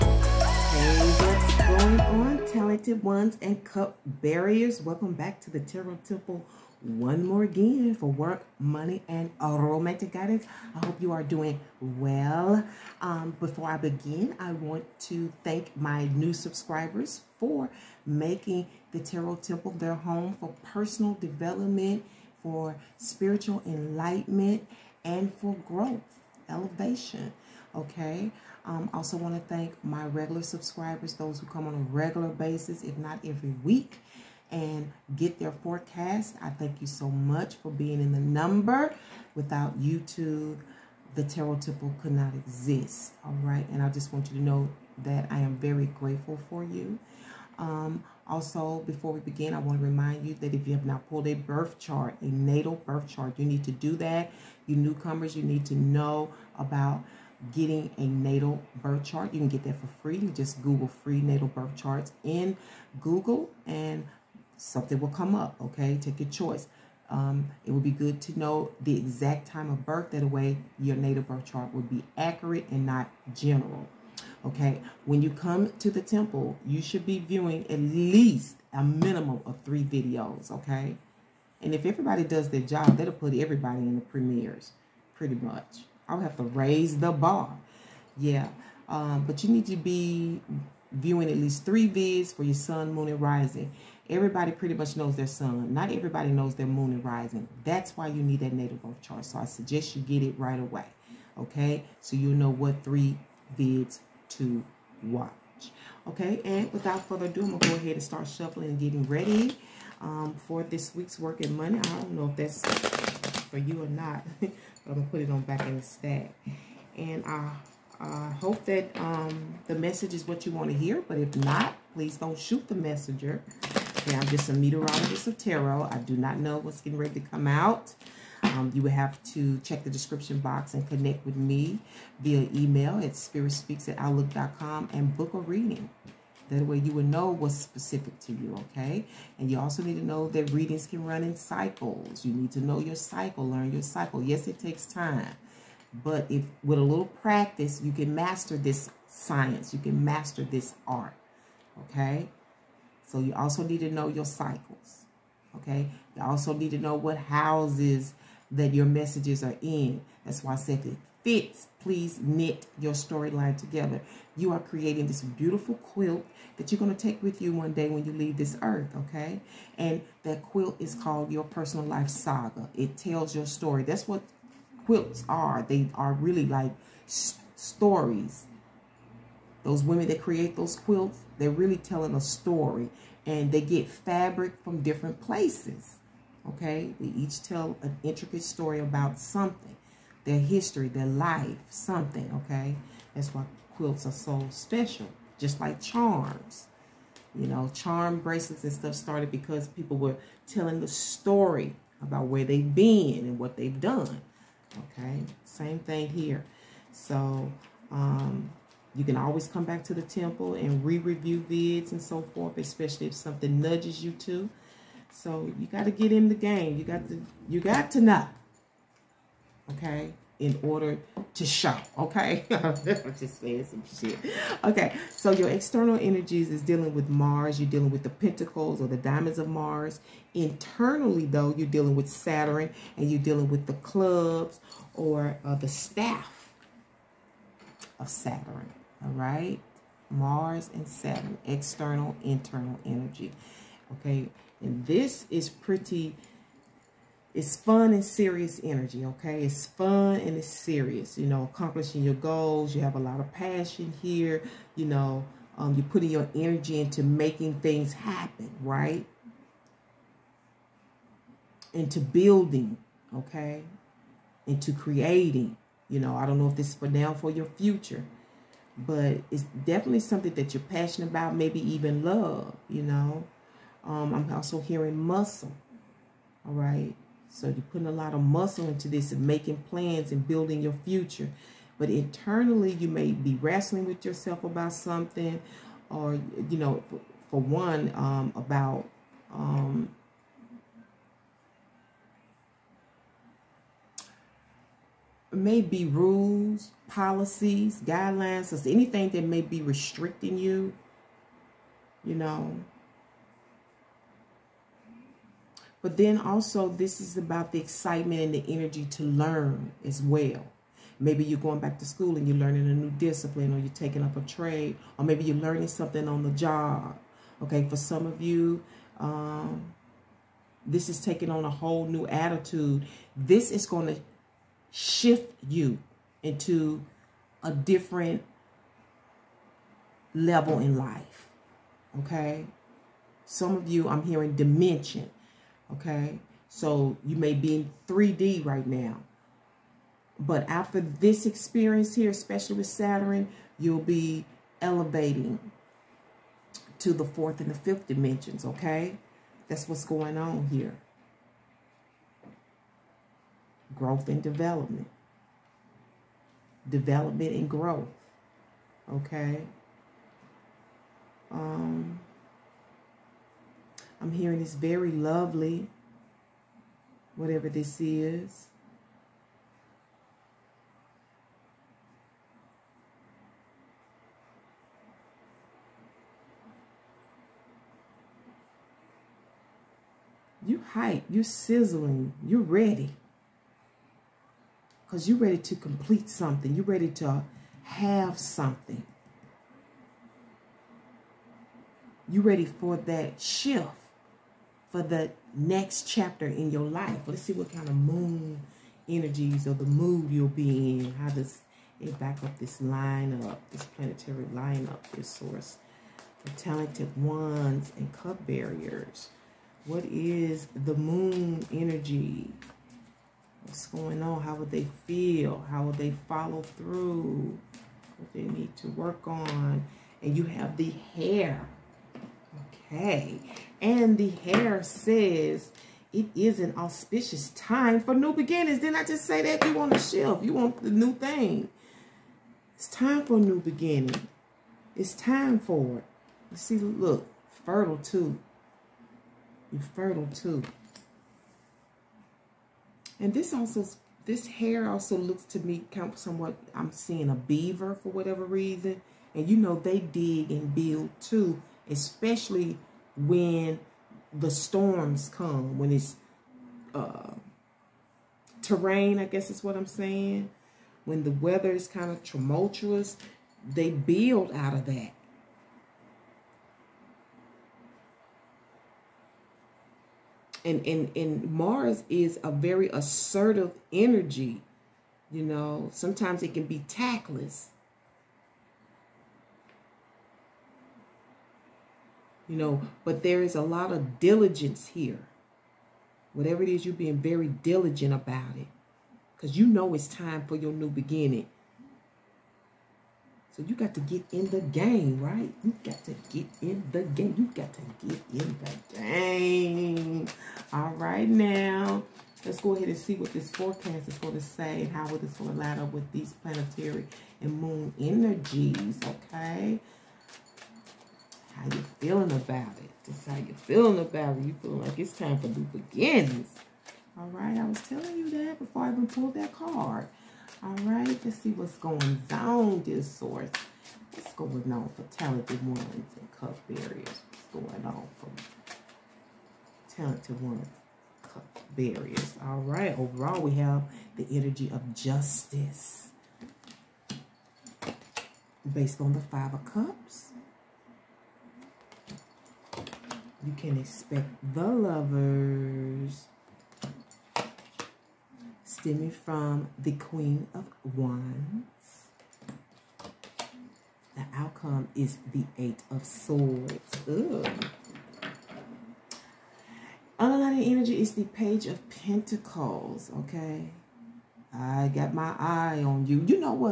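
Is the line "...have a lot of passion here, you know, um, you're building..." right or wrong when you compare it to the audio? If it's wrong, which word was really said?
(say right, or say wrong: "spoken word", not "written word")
wrong: "putting", not "building".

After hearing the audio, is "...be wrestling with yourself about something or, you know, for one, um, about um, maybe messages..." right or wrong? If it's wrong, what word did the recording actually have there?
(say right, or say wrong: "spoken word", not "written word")
wrong: "rules", not "messages".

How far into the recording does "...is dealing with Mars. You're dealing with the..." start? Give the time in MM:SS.
03:46.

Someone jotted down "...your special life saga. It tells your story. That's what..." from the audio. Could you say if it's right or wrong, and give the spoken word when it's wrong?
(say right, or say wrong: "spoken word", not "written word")
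wrong: "personal", not "special".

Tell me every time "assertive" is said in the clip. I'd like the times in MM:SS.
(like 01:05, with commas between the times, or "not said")
07:52.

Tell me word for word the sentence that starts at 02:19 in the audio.
And you also need to know that readings can run in cycles.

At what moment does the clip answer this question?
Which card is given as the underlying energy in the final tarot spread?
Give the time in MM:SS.
09:21.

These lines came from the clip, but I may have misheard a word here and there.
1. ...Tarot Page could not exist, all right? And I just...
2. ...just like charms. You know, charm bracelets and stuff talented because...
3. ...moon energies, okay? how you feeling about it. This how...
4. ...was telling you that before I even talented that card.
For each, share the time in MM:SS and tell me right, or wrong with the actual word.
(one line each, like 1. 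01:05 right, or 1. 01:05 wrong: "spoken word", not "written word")
1. 00:41 wrong: "Temple", not "Page"
2. 03:15 wrong: "started", not "talented"
3. 08:27 right
4. 08:37 wrong: "pulled", not "talented".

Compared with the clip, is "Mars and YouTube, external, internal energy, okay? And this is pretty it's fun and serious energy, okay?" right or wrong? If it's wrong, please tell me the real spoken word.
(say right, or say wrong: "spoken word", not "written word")
wrong: "Saturn", not "YouTube".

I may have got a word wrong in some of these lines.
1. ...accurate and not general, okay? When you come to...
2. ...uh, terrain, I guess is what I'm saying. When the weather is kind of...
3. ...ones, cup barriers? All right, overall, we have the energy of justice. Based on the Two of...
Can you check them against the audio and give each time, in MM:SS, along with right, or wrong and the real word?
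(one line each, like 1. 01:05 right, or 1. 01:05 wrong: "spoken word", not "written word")
1. 01:12 right
2. 07:36 right
3. 08:50 wrong: "Five", not "Two".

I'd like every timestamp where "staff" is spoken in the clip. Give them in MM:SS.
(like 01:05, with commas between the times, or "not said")
03:55.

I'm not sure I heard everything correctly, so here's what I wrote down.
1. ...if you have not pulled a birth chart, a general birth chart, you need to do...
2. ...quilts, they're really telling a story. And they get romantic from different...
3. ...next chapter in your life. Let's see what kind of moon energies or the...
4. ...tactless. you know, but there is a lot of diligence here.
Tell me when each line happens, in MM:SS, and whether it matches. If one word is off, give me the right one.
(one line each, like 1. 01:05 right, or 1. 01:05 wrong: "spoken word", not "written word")
1. 00:50 wrong: "natal", not "general"
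2. 03:00 wrong: "fabric", not "romantic"
3. 06:35 right
4. 07:56 right.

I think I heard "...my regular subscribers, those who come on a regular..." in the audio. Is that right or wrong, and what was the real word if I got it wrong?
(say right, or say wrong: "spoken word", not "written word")
right.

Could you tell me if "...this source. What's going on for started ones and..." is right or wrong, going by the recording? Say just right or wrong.
wrong.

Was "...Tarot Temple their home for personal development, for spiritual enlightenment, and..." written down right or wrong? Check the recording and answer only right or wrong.
right.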